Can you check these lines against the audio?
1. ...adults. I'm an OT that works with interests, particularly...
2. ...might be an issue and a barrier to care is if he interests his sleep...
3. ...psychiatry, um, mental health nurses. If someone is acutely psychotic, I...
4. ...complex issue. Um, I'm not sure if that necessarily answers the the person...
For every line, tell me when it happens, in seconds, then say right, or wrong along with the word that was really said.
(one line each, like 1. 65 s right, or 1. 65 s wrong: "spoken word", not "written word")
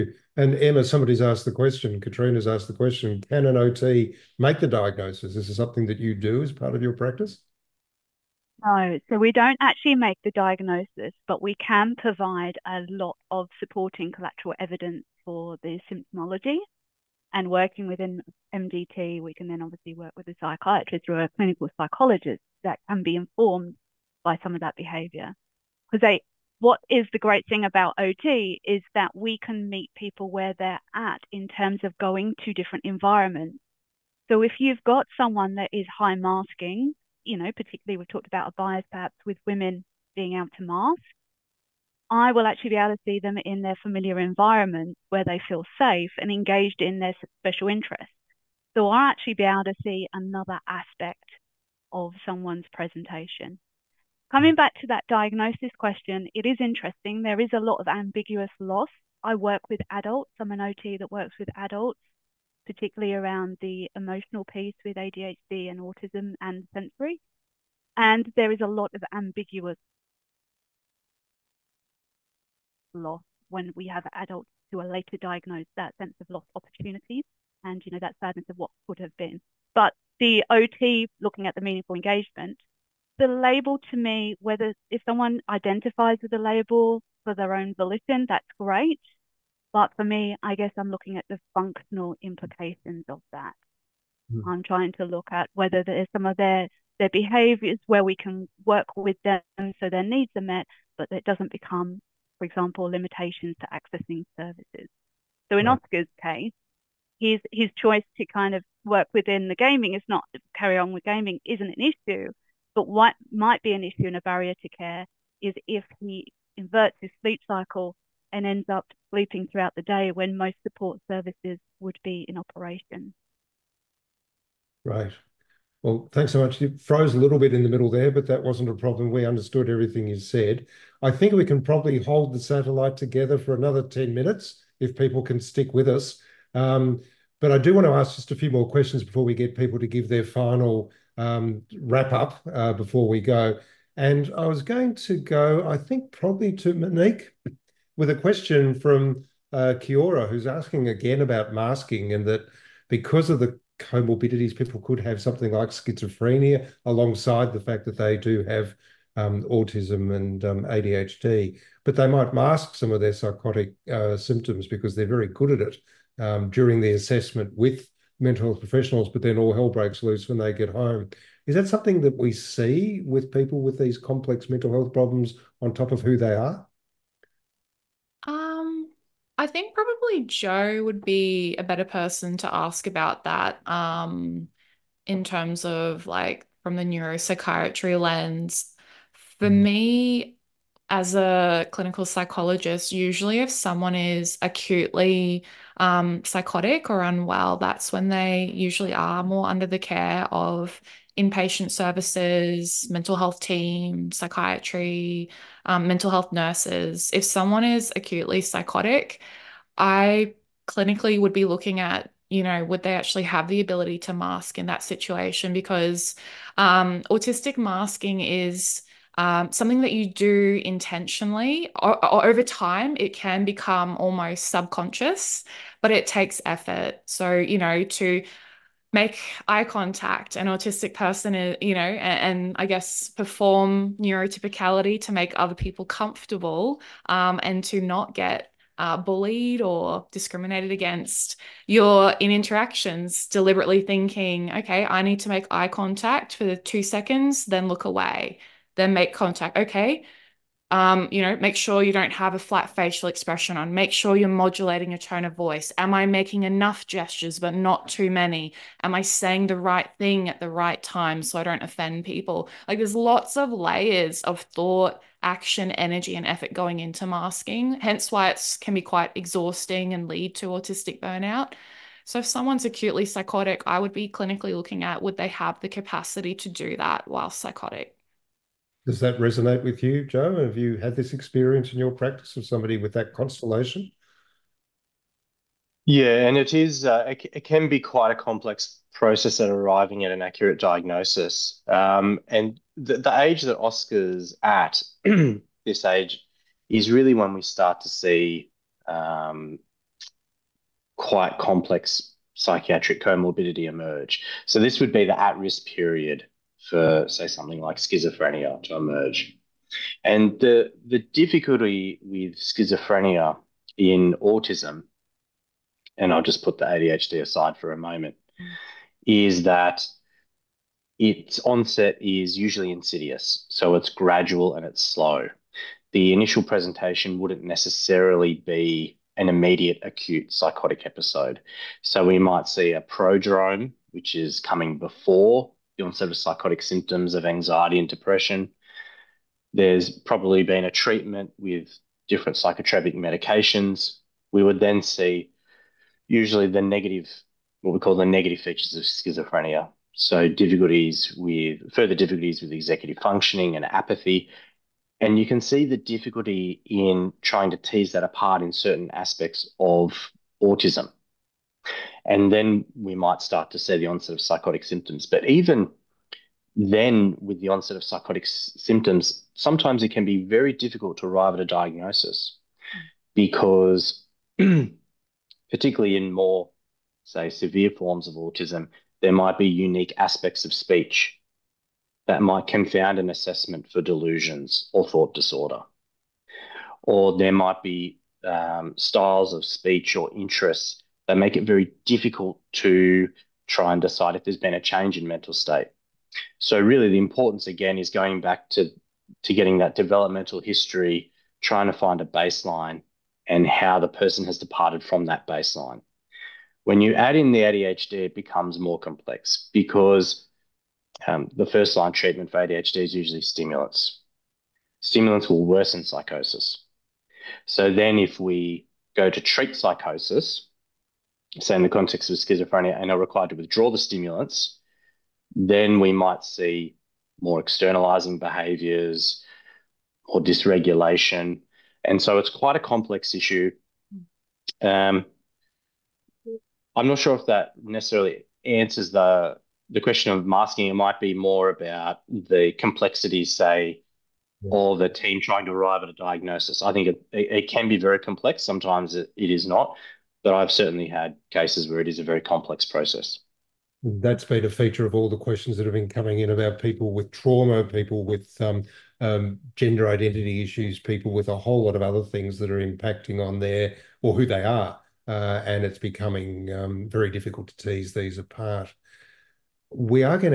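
1. 59 s wrong: "adults", not "interests"
2. 113 s wrong: "inverts", not "interests"
3. 204 s right
4. 432 s wrong: "question", not "person".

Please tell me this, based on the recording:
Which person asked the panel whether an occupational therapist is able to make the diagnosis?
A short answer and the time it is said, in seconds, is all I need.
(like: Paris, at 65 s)
Katrina, at 2 s.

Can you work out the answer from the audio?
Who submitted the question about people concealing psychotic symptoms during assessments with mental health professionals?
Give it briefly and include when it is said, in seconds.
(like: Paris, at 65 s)
Kiora, at 149 s.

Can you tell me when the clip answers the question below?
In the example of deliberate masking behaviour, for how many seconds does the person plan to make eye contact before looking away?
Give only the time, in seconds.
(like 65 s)
246 s.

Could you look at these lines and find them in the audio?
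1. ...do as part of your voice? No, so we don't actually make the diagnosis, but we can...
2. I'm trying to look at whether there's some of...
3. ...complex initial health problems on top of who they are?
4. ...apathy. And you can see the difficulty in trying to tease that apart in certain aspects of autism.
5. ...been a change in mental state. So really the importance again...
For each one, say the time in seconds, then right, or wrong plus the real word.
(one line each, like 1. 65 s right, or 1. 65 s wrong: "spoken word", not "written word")
1. 6 s wrong: "practice", not "voice"
2. 94 s right
3. 173 s wrong: "mental", not "initial"
4. 353 s right
5. 394 s right.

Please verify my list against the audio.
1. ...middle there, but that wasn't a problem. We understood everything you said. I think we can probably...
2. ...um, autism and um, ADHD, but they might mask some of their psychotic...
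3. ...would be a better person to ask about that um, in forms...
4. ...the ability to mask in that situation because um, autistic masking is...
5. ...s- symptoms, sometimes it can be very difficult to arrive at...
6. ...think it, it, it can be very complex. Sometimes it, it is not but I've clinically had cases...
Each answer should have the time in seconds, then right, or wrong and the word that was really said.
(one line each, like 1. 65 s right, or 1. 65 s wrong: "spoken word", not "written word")
1. 127 s right
2. 159 s right
3. 180 s wrong: "terms", not "forms"
4. 213 s right
5. 368 s right
6. 446 s wrong: "certainly", not "clinically".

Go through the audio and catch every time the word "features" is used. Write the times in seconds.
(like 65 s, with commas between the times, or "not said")
348 s, 454 s.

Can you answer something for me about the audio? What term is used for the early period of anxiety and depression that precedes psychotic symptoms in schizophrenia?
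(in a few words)
Prodrome.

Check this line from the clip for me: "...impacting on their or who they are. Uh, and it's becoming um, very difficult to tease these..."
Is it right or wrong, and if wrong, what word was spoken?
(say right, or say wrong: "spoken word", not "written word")
right.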